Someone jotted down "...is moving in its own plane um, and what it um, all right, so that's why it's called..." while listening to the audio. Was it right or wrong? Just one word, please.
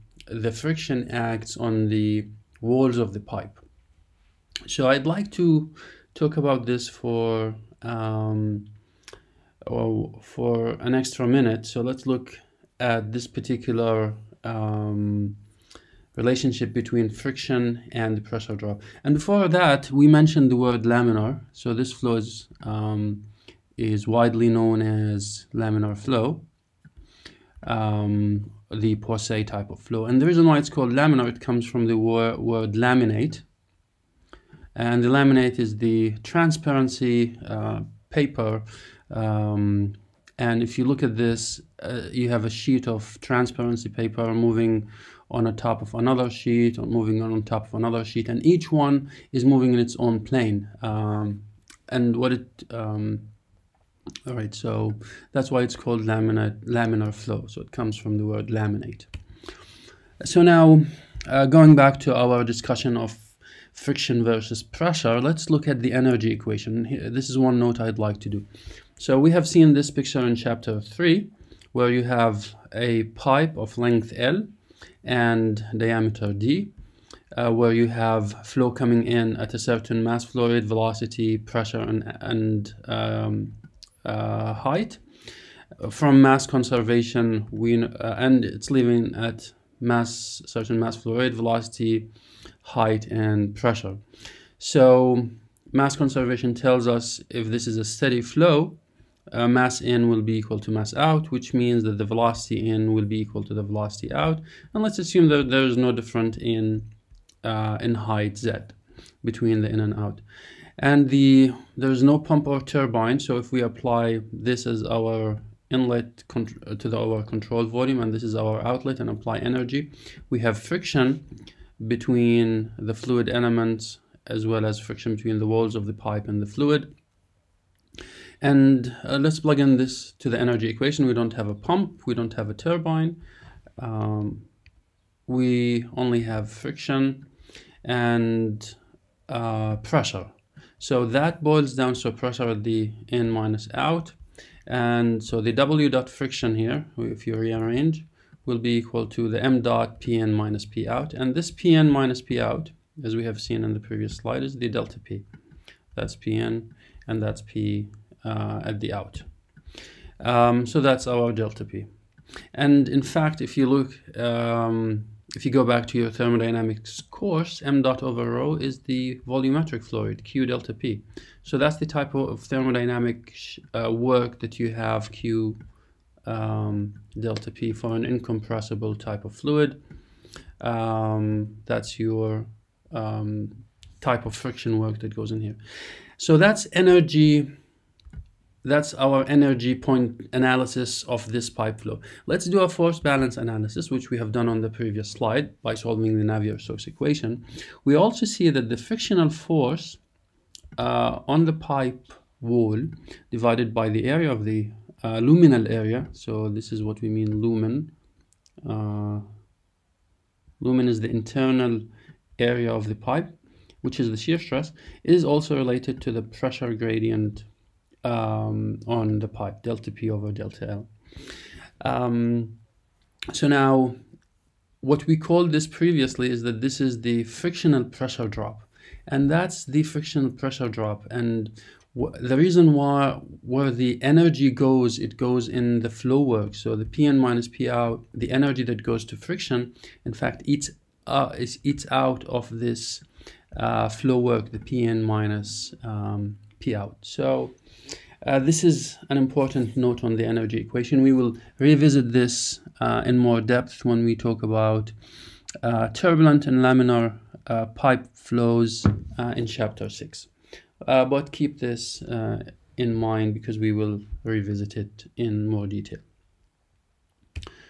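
right.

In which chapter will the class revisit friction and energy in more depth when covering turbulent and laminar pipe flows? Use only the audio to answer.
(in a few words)
chapter 6.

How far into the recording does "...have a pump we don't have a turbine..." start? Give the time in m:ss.
2:11.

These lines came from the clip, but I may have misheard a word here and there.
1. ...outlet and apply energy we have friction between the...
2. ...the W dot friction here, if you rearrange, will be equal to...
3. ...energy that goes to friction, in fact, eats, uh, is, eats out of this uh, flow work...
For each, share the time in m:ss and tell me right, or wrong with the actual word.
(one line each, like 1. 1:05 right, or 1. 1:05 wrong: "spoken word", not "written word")
1. 1:58 right
2. 2:25 right
3. 3:58 right.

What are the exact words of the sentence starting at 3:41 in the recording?
Um, so now what we called this previously is that this is the frictional pressure drop.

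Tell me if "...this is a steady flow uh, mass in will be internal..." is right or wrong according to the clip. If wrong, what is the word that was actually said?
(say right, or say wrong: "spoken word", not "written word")
wrong: "equal", not "internal".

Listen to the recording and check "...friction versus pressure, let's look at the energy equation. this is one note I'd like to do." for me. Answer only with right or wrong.
right.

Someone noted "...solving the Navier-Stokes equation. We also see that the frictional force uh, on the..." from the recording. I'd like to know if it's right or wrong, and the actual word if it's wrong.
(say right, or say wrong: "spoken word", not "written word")
right.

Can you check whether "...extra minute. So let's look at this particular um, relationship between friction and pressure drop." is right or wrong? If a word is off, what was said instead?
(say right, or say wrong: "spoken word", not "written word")
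right.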